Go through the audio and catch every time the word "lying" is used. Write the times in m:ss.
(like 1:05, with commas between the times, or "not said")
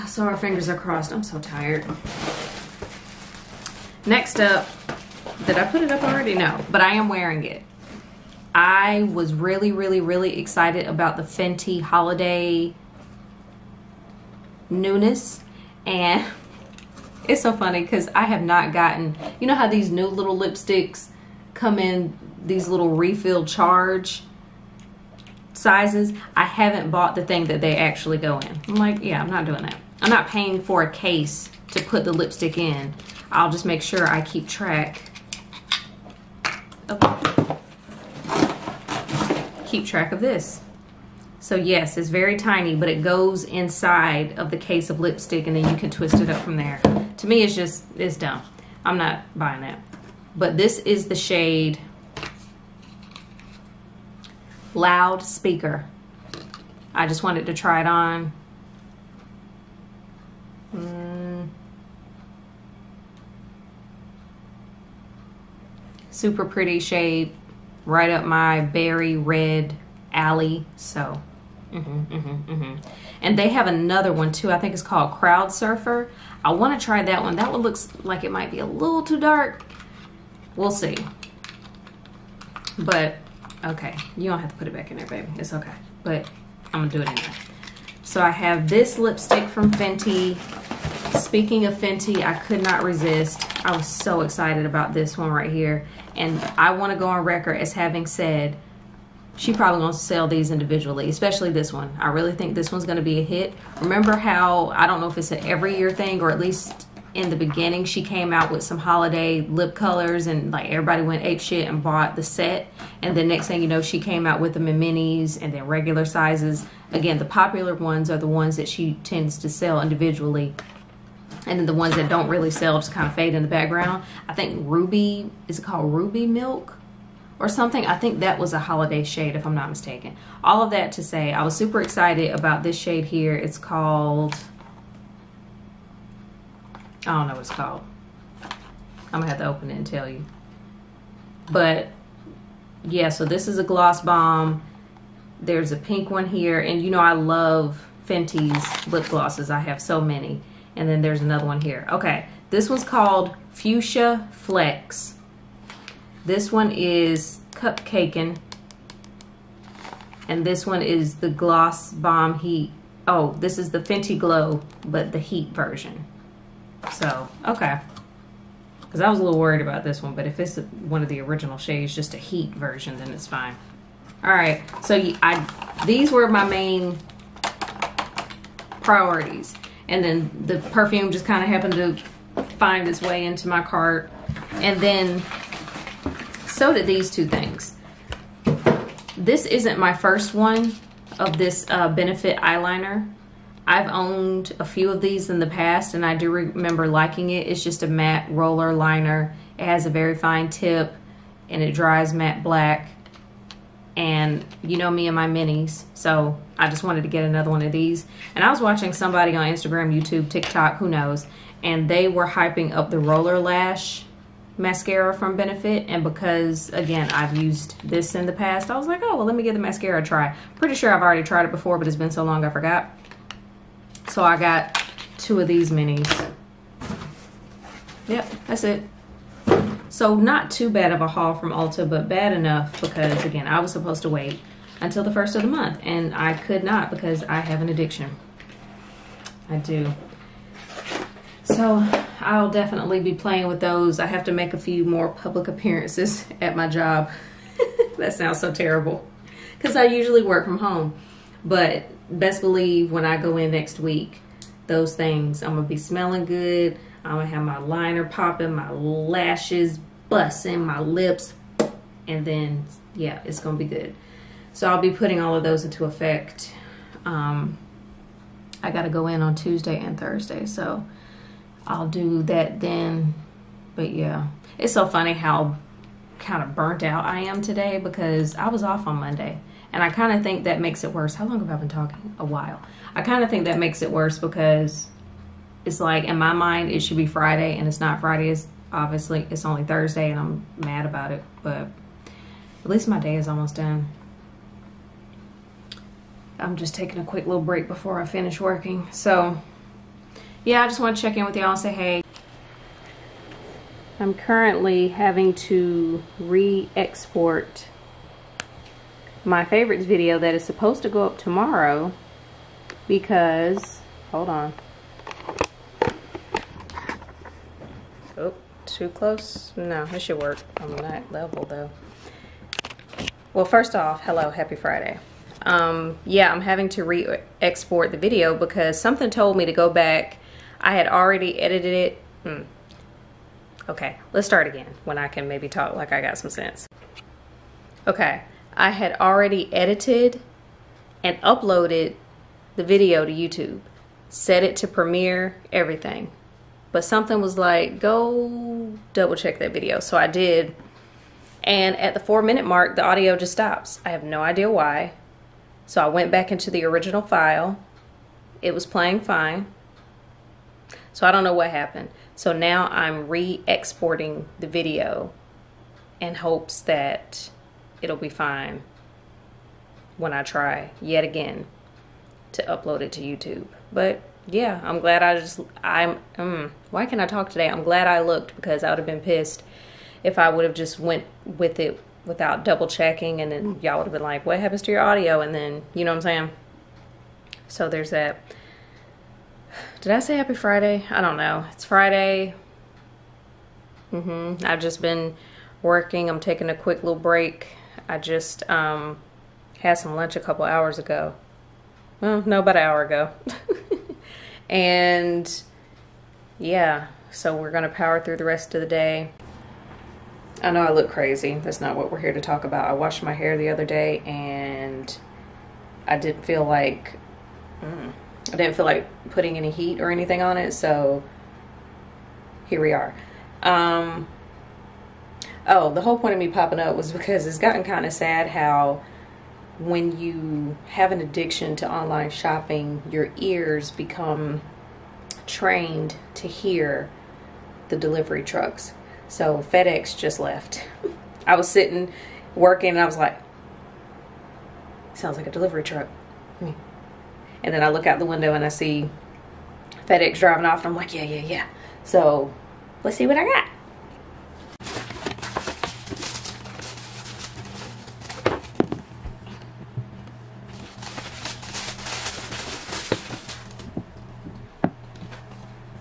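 not said.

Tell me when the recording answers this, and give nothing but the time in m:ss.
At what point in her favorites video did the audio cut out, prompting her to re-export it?
5:51.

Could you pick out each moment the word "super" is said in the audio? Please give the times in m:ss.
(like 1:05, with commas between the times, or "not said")
1:06, 2:11.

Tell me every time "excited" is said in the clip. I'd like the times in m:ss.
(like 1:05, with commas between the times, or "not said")
0:10, 1:34, 2:11.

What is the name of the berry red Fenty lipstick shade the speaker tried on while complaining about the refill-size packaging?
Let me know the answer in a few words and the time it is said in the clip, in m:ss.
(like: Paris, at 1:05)
Loud Speaker, at 0:54.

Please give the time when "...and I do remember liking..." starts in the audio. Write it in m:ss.
3:15.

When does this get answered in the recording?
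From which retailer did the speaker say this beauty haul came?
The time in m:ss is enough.
3:51.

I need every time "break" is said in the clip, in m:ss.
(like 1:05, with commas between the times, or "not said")
4:57, 6:36.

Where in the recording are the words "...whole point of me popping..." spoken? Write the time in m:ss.
7:05.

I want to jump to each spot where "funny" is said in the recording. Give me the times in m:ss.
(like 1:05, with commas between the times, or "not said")
0:17, 4:34.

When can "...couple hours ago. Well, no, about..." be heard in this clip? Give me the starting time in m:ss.
6:40.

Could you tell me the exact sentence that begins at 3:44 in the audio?
So I got two of these minis.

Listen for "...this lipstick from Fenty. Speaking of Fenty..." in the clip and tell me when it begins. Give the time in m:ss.
1:28.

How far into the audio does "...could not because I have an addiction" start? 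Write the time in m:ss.
3:56.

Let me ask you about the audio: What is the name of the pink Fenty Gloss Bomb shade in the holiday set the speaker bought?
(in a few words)
Fuchsia Flex.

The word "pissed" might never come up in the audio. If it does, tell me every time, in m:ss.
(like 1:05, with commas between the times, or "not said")
6:18.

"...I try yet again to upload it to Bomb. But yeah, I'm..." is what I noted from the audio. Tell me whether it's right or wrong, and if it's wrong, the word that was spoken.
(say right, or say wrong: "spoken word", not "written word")
wrong: "YouTube", not "Bomb".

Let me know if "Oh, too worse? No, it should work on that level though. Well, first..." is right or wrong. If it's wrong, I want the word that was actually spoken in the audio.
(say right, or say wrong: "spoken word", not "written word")
wrong: "close", not "worse".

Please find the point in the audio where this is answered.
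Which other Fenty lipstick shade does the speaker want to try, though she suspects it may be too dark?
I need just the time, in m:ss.
1:15.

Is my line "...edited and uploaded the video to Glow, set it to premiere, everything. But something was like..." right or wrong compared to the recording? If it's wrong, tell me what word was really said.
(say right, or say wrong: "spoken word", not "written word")
wrong: "YouTube", not "Glow".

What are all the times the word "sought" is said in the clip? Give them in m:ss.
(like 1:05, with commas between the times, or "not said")
not said.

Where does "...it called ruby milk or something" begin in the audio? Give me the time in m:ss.
2:05.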